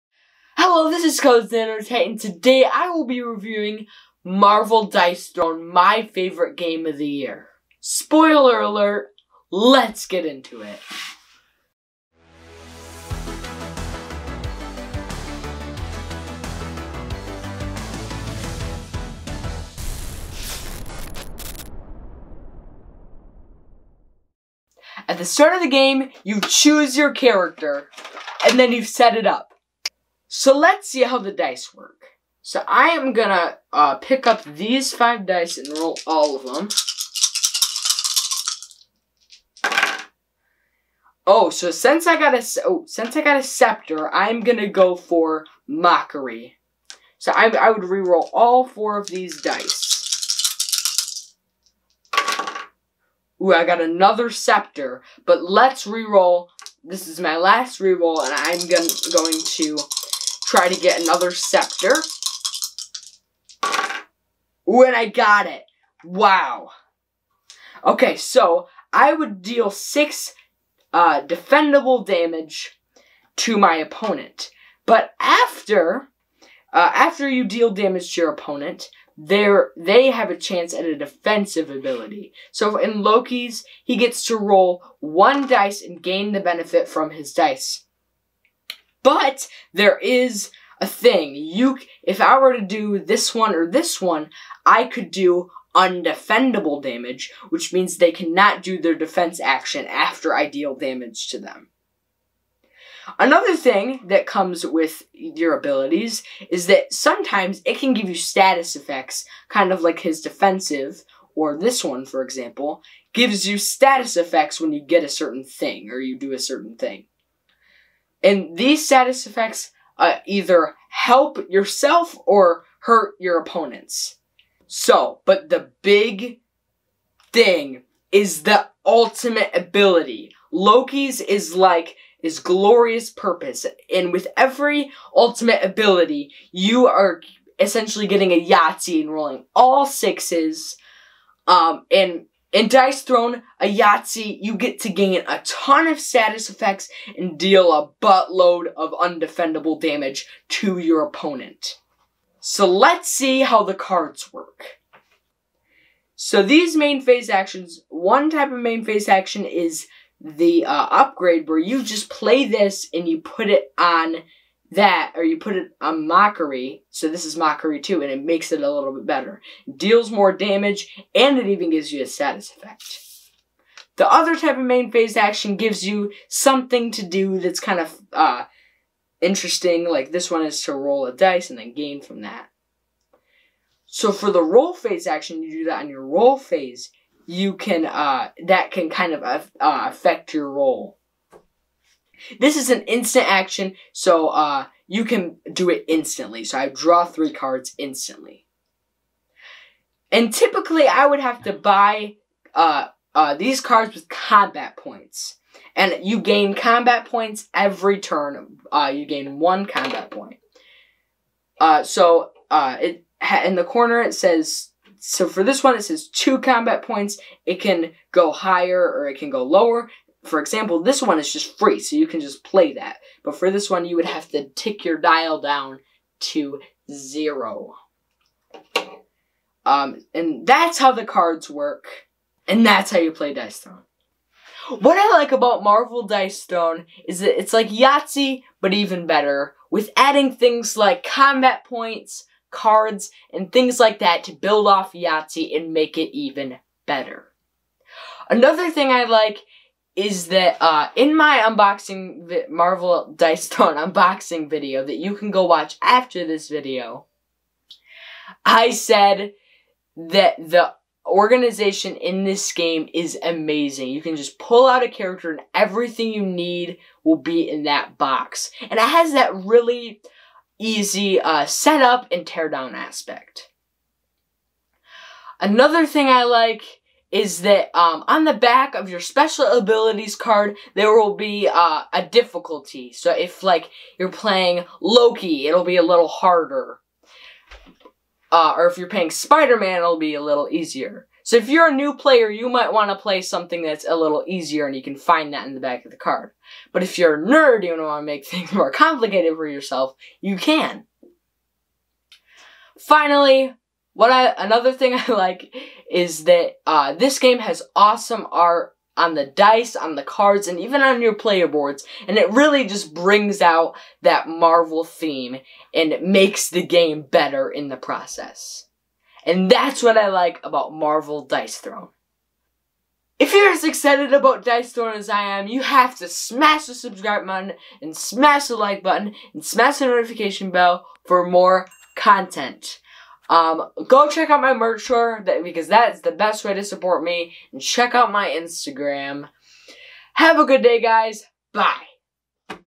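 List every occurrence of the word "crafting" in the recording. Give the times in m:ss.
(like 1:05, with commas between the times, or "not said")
not said.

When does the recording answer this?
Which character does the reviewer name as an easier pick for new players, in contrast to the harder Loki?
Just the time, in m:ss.
4:49.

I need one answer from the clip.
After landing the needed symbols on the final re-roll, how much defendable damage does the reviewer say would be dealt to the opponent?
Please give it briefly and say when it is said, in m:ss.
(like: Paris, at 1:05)
6, at 1:09.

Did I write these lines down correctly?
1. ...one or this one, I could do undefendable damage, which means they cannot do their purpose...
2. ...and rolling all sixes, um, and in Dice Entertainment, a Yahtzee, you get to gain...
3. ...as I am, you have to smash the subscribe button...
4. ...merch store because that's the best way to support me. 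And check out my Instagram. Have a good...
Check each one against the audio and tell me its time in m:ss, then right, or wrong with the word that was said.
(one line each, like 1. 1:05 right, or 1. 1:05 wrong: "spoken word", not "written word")
1. 1:33 wrong: "defense", not "purpose"
2. 2:19 wrong: "Throne", not "Entertainment"
3. 5:24 right
4. 5:34 right.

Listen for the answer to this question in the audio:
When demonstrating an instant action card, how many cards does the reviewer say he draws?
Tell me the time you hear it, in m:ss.
3:17.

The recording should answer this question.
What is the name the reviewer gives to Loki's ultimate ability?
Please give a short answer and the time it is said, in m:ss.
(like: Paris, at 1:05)
glorious purpose, at 2:12.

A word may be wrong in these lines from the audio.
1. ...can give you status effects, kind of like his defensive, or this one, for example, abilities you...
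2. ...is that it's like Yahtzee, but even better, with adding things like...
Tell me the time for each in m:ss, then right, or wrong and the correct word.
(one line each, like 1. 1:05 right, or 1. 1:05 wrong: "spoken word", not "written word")
1. 1:47 wrong: "gives", not "abilities"
2. 3:57 right.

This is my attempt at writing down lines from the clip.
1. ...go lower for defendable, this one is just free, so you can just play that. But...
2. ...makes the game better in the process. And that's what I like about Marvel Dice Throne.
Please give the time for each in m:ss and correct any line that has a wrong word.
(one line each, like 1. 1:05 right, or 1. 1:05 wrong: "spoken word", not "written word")
1. 3:39 wrong: "example", not "defendable"
2. 5:16 right.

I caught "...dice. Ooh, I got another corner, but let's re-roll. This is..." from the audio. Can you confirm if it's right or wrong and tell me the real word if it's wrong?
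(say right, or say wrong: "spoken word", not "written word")
wrong: "scepter", not "corner".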